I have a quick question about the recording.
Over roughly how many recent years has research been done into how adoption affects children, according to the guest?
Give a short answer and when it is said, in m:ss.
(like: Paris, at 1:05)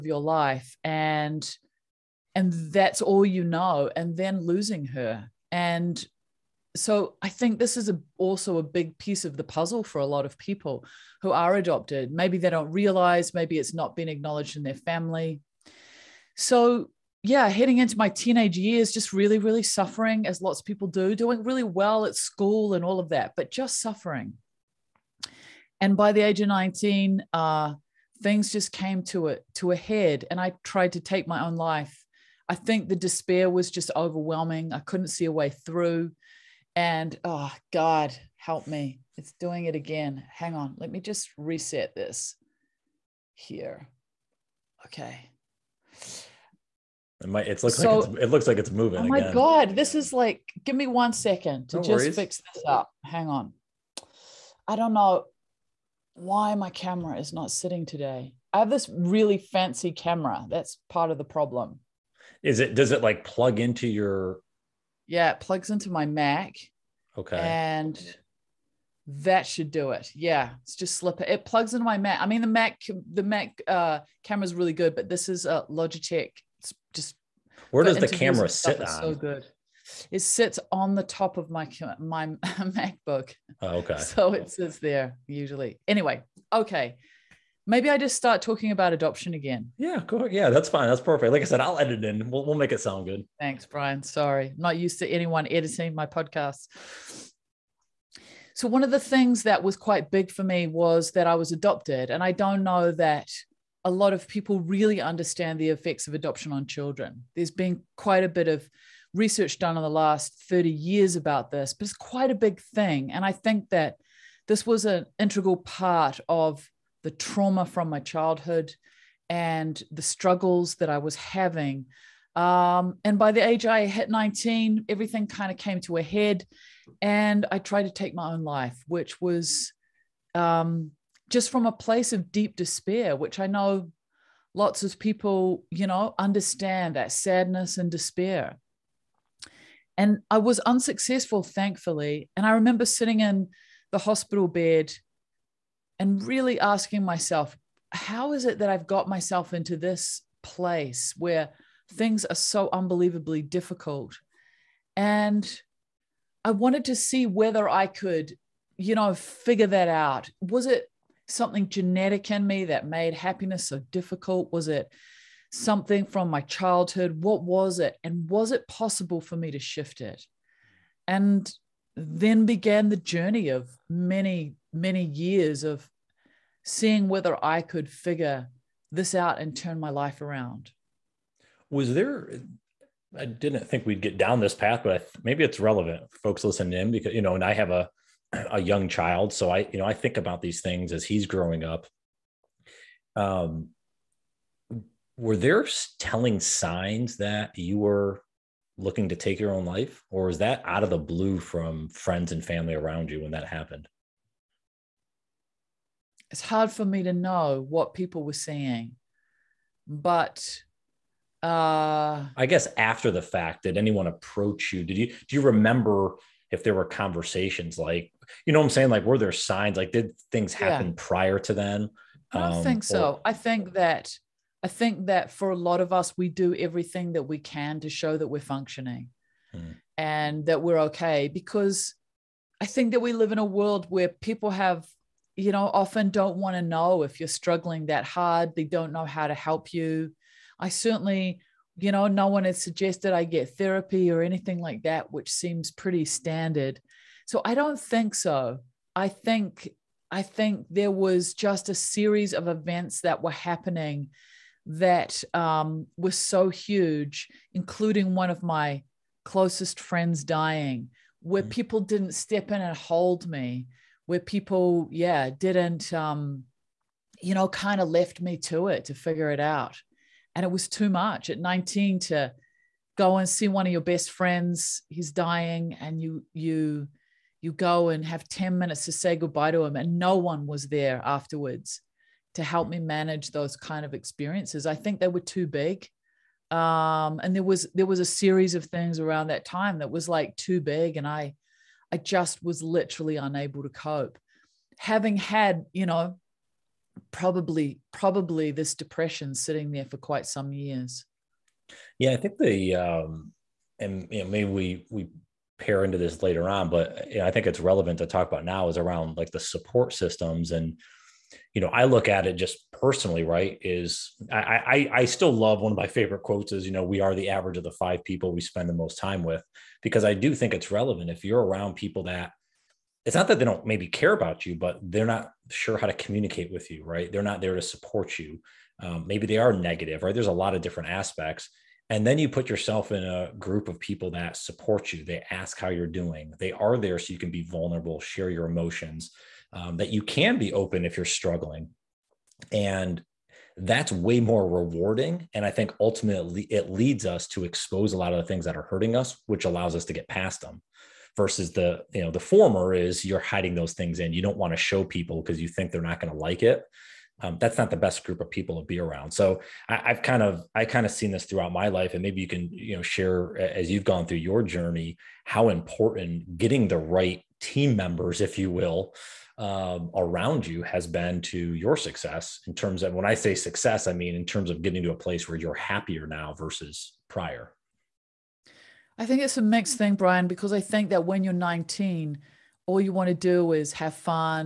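30 years, at 1:50.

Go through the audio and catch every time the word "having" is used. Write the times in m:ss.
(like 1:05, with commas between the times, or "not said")
2:01, 4:54.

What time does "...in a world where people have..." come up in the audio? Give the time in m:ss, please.
3:53.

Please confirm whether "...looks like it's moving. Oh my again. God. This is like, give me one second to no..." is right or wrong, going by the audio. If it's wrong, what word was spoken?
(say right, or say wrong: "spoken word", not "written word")
right.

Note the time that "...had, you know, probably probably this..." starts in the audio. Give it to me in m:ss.
4:55.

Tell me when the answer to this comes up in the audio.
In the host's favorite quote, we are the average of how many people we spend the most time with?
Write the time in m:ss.
5:17.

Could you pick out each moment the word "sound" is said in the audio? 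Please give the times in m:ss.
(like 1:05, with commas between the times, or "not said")
1:32.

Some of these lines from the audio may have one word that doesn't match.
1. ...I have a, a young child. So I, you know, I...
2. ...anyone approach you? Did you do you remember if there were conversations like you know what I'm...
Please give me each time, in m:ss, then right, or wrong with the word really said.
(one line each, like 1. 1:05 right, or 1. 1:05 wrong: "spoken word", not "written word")
1. 3:07 right
2. 3:33 right.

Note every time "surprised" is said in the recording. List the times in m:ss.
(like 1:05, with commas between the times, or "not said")
not said.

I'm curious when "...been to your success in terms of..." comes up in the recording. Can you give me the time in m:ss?
6:10.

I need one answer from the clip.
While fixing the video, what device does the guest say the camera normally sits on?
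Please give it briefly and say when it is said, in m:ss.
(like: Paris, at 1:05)
MacBook, at 1:22.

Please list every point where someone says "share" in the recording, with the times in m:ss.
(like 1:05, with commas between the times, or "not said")
5:37, 6:02.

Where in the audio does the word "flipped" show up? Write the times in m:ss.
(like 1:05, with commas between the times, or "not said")
not said.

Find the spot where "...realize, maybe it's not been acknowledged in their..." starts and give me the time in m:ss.
0:12.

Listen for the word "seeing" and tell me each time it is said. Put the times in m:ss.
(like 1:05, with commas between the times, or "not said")
2:56, 3:28.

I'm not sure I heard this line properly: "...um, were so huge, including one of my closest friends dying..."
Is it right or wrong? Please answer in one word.
right.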